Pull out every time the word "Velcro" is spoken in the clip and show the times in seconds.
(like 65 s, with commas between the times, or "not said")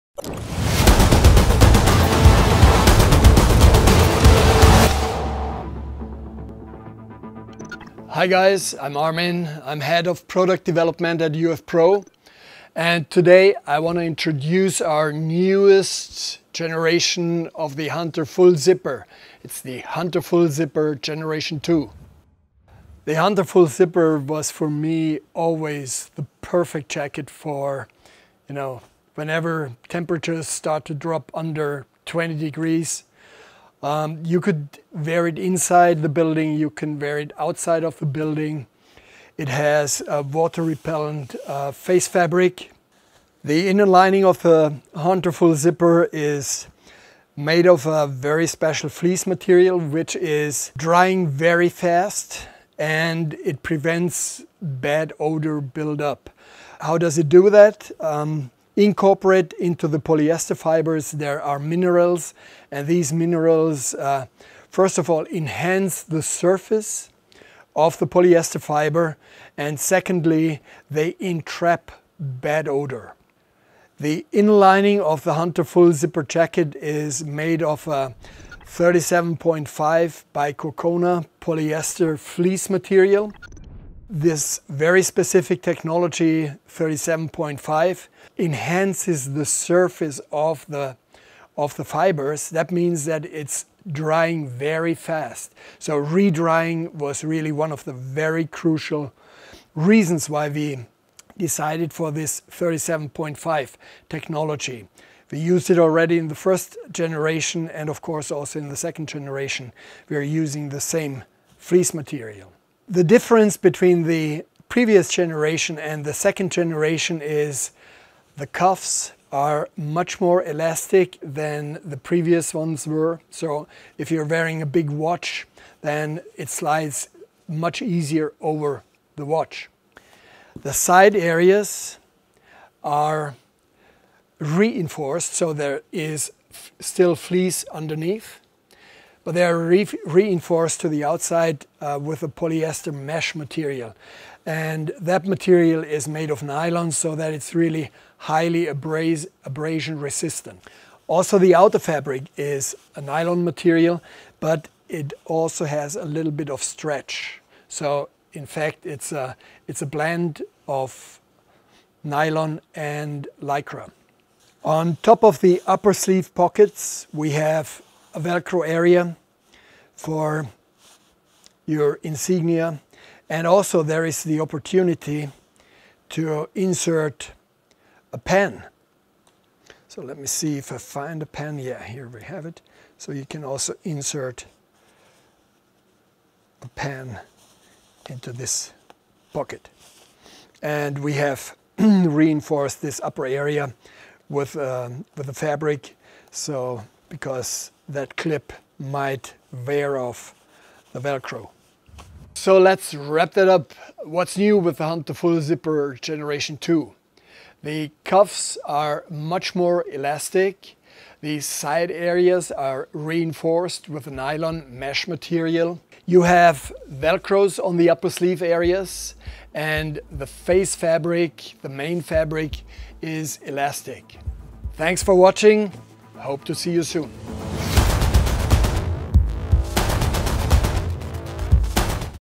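168 s, 200 s, 216 s.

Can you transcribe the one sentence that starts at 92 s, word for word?
That means that it's drying very fast.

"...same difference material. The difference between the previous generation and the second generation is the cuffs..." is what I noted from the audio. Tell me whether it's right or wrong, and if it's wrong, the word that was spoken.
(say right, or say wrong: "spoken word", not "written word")
wrong: "fleece", not "difference".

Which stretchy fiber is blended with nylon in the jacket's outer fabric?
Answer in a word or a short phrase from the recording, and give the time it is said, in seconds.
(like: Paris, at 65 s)
Lycra, at 163 s.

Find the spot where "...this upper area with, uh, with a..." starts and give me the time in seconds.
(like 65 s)
192 s.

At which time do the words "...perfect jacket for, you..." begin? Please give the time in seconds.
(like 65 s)
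26 s.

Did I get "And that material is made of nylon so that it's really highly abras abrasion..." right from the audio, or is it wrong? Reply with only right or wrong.
right.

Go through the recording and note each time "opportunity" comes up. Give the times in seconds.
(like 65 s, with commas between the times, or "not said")
174 s.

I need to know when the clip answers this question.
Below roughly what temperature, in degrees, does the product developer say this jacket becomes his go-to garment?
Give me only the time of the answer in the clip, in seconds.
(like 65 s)
32 s.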